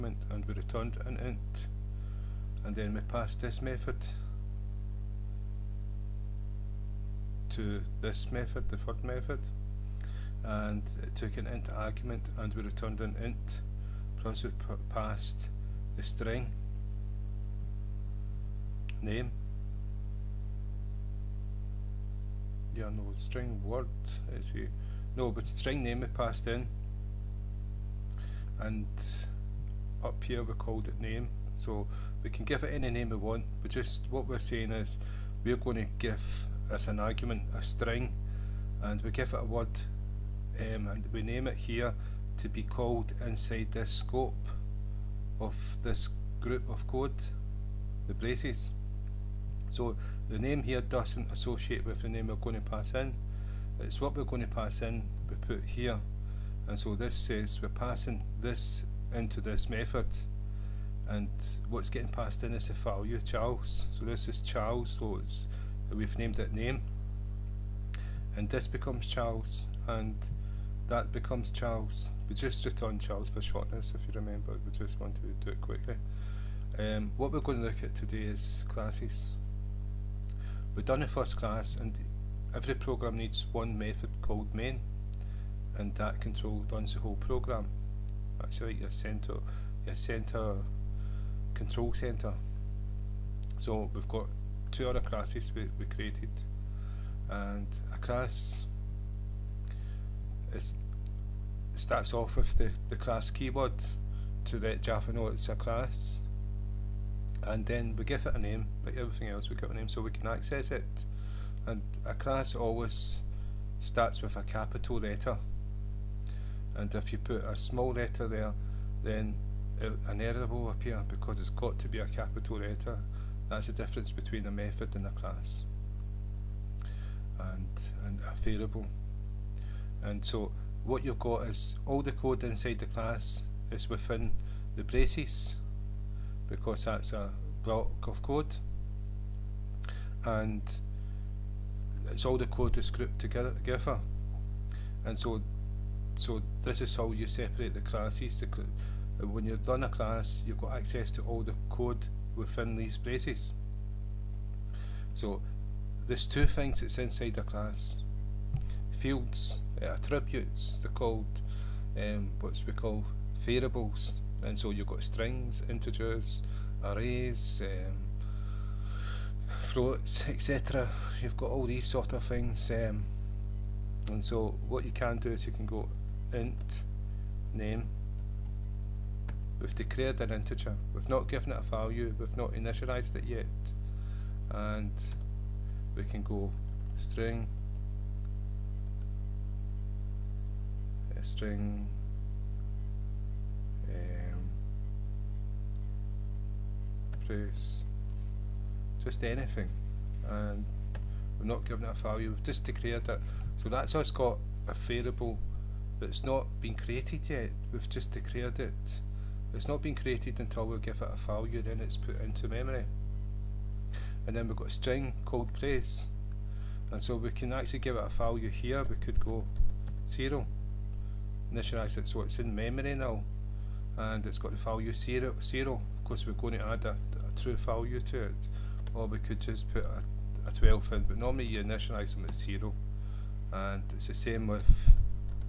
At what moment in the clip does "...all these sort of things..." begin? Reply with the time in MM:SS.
02:51.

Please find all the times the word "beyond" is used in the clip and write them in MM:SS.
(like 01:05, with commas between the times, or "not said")
not said.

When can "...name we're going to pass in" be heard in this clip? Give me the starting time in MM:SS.
00:52.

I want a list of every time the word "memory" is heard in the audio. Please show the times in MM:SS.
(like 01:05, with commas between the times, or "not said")
03:32, 03:42.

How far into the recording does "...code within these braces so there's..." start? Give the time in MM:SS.
02:31.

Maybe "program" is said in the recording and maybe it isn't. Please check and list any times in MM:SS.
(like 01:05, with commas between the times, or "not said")
01:22, 01:27.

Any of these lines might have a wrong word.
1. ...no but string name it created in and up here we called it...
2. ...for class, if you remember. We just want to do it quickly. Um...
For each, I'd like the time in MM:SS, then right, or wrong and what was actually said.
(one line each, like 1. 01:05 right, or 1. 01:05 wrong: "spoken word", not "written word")
1. 00:25 wrong: "passed", not "created"
2. 01:13 wrong: "shortness", not "class".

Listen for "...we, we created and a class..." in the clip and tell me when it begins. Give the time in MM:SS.
01:35.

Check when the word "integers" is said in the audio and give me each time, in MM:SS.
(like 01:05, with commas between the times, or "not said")
02:45, 03:00.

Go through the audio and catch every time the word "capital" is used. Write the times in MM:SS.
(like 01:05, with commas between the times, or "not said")
01:54, 02:02.